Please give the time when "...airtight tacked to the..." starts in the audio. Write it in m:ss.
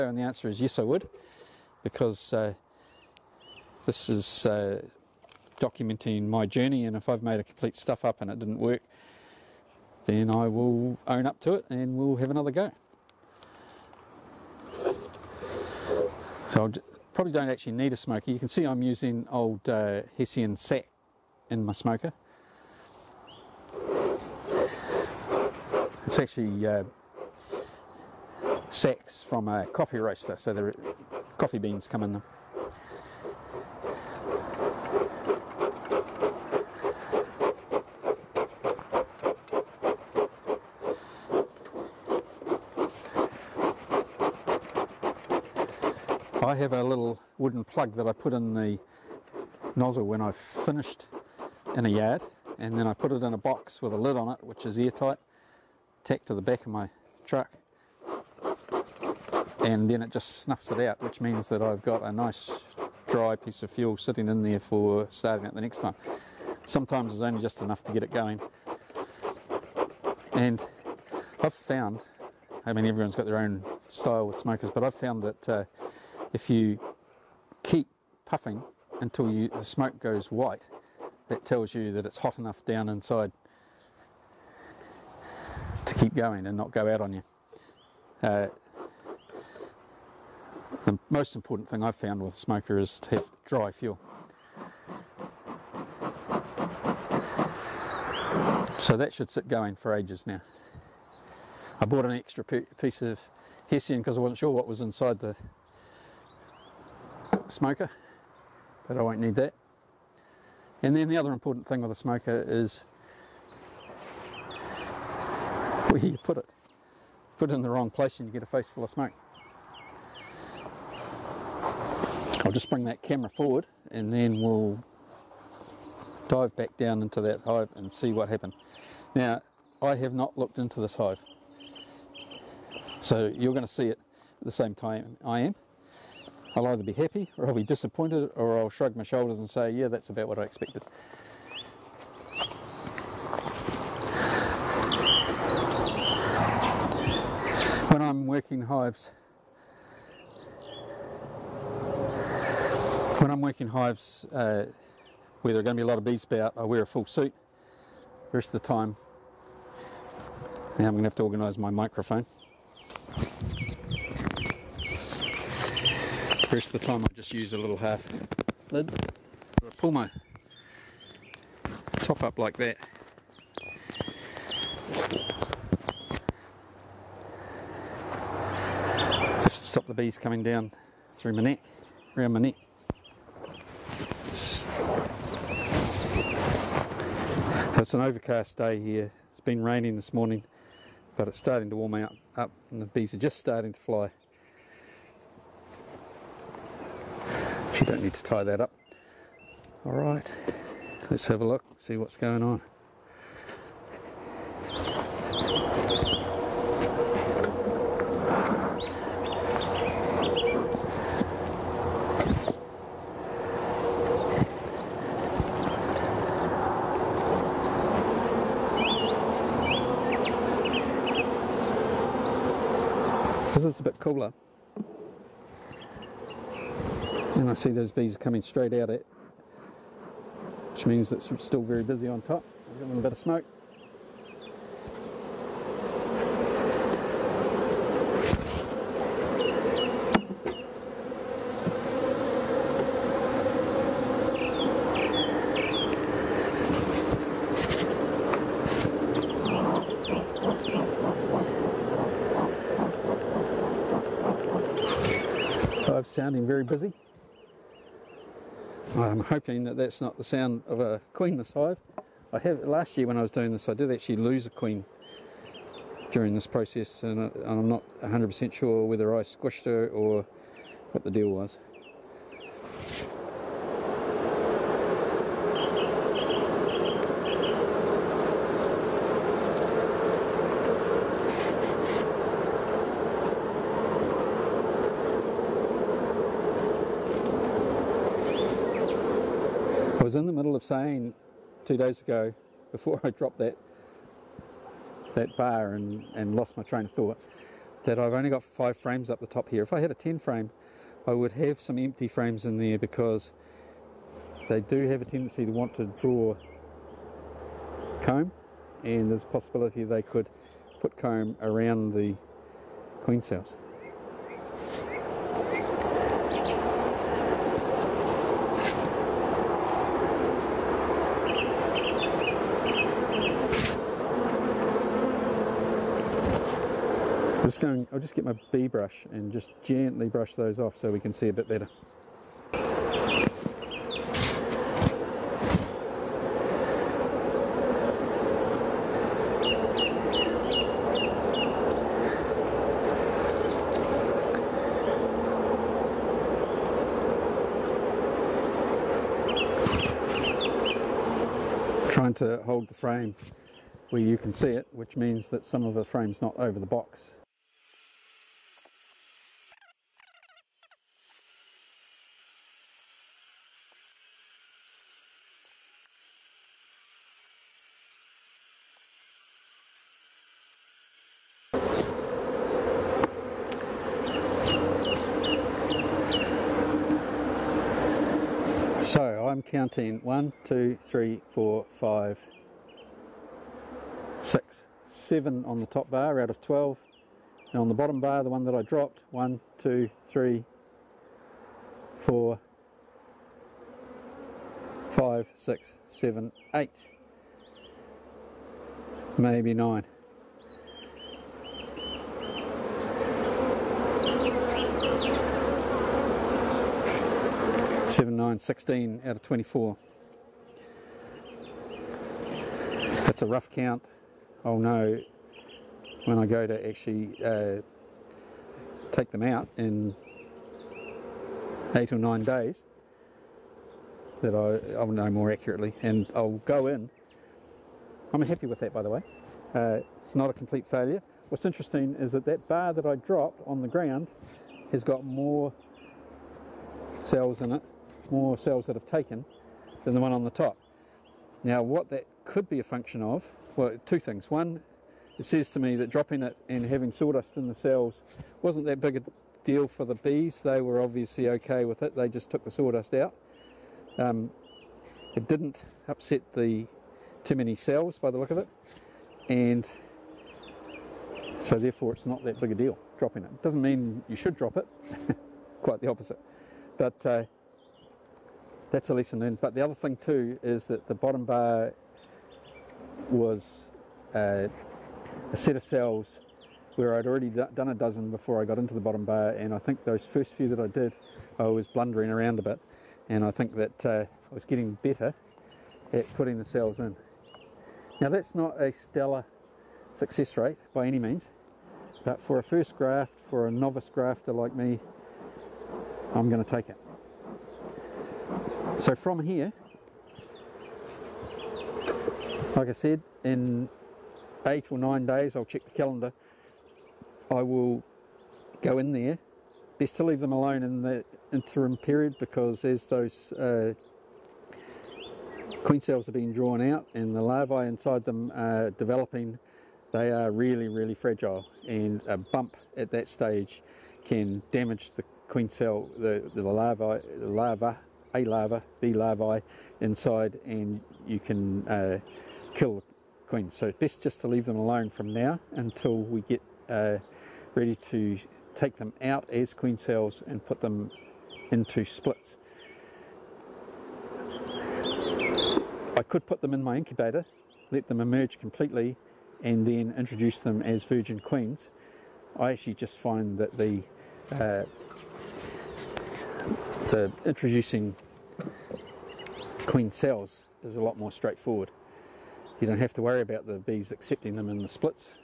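0:54.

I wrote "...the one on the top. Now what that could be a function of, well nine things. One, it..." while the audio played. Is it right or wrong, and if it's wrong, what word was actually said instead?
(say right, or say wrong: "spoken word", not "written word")
wrong: "two", not "nine".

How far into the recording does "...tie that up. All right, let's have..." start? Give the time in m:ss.
3:18.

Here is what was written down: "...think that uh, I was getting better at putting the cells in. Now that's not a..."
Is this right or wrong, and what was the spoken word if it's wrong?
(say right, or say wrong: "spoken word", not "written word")
right.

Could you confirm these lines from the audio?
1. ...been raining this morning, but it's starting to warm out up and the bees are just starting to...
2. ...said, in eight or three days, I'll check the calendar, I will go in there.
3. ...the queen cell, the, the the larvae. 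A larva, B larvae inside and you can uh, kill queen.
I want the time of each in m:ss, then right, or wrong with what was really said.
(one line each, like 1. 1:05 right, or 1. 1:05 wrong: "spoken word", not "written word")
1. 3:09 right
2. 8:22 wrong: "nine", not "three"
3. 8:44 right.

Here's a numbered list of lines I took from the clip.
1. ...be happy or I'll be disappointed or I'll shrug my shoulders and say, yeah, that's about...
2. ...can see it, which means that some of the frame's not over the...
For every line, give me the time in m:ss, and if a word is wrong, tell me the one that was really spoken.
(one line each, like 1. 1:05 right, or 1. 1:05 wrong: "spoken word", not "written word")
1. 2:16 right
2. 5:54 right.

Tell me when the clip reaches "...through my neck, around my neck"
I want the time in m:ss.
3:01.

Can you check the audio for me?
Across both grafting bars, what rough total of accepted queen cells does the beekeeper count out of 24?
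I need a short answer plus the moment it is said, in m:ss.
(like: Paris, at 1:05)
16, at 6:48.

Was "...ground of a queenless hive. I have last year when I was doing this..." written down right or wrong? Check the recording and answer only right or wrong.
wrong.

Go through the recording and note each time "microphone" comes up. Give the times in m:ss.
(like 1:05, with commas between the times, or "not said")
2:41.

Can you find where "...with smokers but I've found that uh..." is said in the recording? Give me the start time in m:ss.
1:14.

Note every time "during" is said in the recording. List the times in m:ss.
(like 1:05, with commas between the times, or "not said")
4:26.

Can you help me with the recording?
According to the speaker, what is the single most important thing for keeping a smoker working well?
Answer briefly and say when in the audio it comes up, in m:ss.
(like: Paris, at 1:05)
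dry fuel, at 1:33.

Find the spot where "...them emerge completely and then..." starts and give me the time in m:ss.
9:07.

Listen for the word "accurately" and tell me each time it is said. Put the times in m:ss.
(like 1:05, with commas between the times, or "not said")
7:05.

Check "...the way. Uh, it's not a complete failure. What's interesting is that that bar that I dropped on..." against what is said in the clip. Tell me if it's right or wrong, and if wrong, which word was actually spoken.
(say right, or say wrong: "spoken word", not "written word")
right.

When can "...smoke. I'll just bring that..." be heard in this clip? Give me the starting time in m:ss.
1:58.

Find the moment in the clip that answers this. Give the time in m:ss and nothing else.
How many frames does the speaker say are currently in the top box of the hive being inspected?
4:58.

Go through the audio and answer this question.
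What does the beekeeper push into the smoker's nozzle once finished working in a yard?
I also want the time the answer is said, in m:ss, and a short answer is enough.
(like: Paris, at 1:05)
a little wooden plug, at 0:46.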